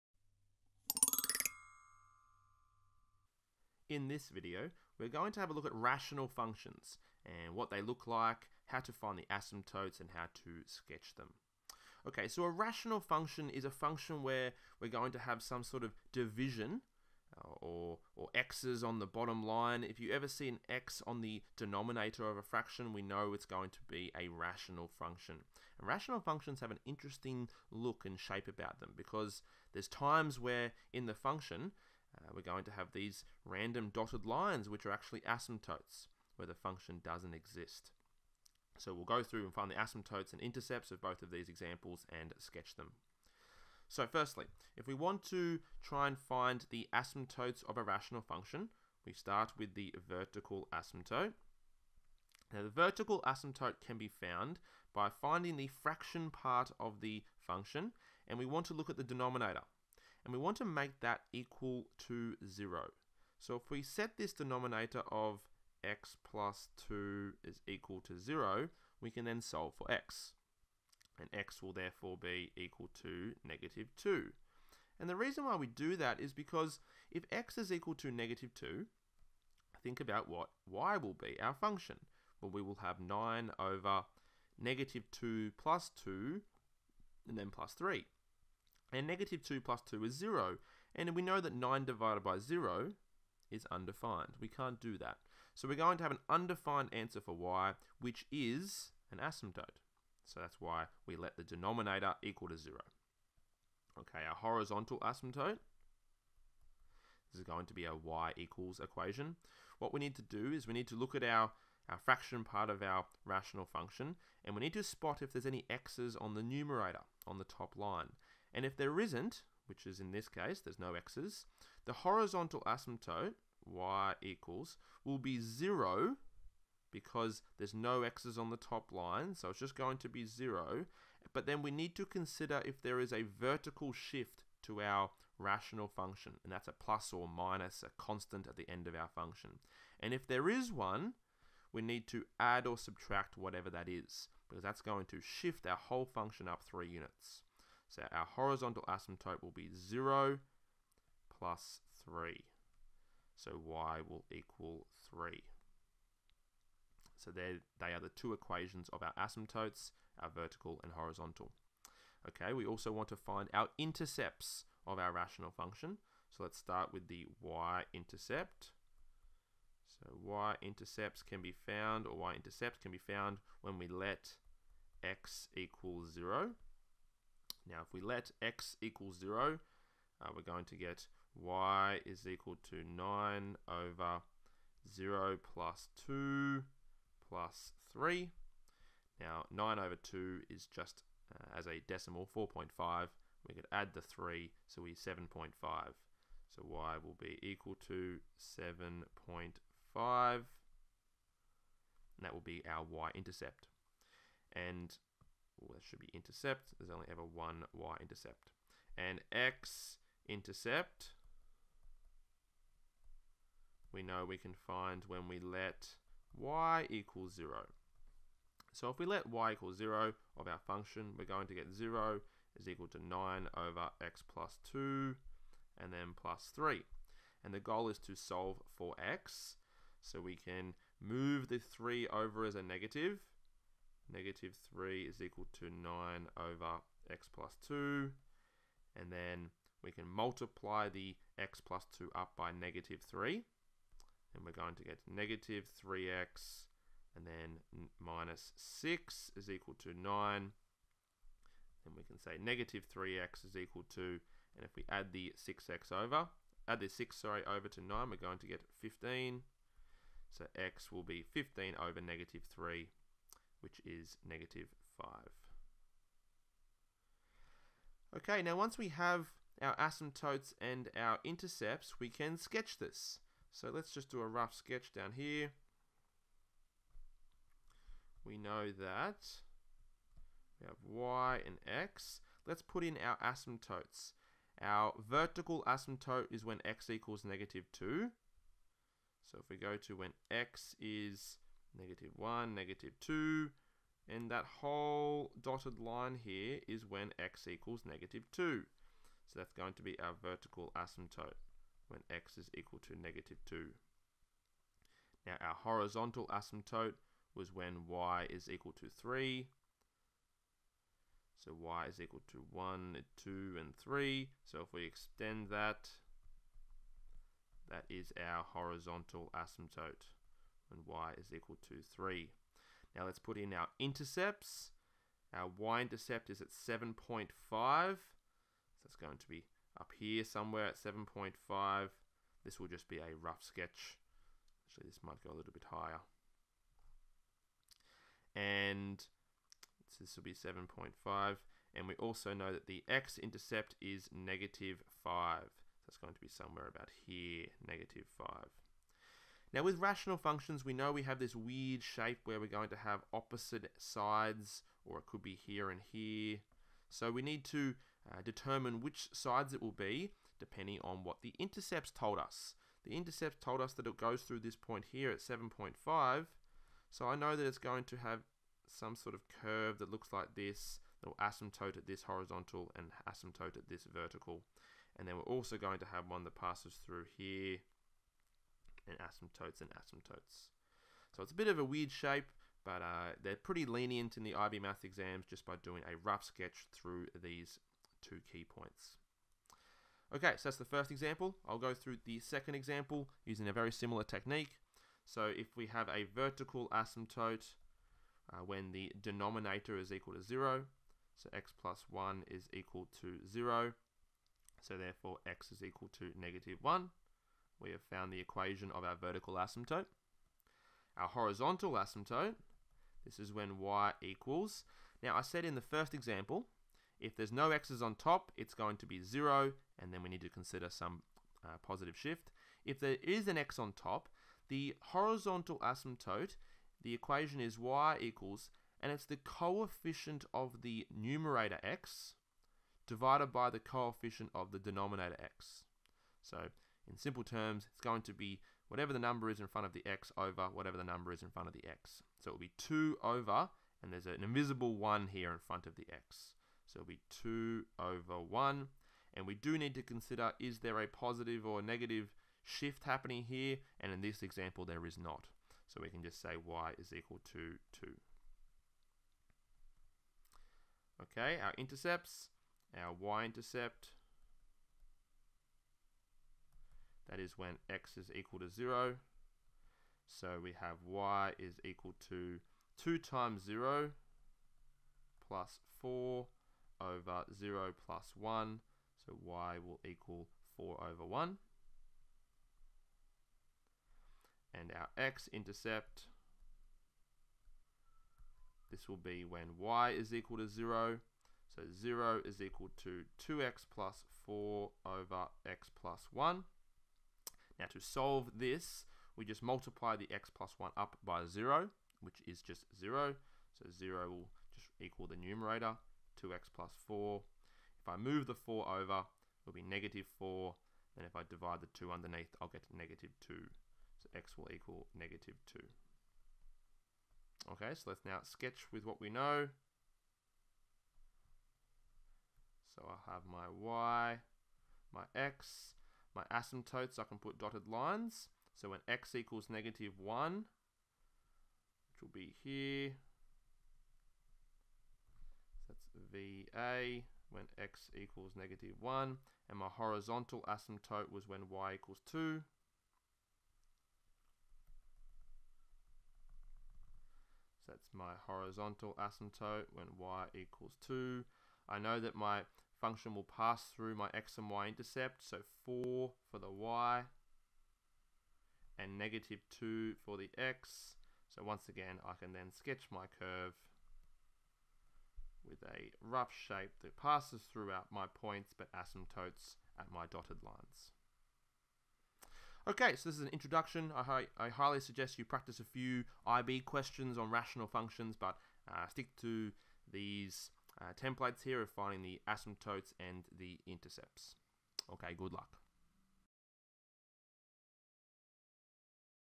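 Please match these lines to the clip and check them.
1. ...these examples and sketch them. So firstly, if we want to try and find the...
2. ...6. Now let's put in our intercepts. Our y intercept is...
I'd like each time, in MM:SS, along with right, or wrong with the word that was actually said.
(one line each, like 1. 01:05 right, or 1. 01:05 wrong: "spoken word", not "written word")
1. 00:41 right
2. 05:21 wrong: "3", not "6".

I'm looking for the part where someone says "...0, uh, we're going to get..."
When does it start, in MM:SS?
02:59.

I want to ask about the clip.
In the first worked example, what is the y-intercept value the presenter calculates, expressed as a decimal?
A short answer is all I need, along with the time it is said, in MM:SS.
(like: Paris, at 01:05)
7.5, at 03:16.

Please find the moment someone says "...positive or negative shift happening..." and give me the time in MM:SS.
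07:30.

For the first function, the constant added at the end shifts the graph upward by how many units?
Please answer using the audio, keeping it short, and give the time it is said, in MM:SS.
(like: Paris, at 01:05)
3 units, at 02:26.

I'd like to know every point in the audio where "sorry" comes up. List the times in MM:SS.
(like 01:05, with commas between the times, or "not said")
04:17.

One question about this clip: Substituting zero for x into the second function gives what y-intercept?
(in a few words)
4.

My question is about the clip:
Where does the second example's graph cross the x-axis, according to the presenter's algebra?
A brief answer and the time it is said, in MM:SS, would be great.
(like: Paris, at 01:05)
-2, at 08:34.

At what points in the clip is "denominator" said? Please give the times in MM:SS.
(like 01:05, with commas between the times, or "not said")
00:21, 00:59, 01:04, 01:41, 06:39, 07:14.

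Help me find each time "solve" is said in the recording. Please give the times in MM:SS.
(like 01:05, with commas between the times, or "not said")
01:09, 03:48, 08:17.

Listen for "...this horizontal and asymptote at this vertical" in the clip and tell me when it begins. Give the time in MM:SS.
06:11.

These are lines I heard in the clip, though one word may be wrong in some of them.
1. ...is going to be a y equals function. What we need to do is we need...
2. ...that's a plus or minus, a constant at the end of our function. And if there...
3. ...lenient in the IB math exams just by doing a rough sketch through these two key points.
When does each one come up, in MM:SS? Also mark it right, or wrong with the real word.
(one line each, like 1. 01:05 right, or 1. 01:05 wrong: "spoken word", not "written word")
1. 01:47 wrong: "equation", not "function"
2. 02:16 right
3. 06:23 right.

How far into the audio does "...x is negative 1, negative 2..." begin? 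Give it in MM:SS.
04:50.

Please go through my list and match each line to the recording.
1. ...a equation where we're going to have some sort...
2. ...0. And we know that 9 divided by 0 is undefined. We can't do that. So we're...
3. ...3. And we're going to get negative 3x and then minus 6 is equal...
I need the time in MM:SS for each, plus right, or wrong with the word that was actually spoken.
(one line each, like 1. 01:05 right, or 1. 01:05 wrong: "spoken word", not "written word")
1. 00:13 wrong: "function", not "equation"
2. 01:30 right
3. 04:03 right.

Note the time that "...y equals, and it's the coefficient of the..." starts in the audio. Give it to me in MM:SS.
07:07.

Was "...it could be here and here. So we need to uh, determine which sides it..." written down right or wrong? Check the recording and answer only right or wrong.
right.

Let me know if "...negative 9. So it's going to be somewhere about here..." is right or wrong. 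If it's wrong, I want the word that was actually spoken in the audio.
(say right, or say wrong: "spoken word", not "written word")
wrong: "5", not "9".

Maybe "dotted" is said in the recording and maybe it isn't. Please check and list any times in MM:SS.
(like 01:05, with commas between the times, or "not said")
00:33, 04:55, 08:47, 09:30.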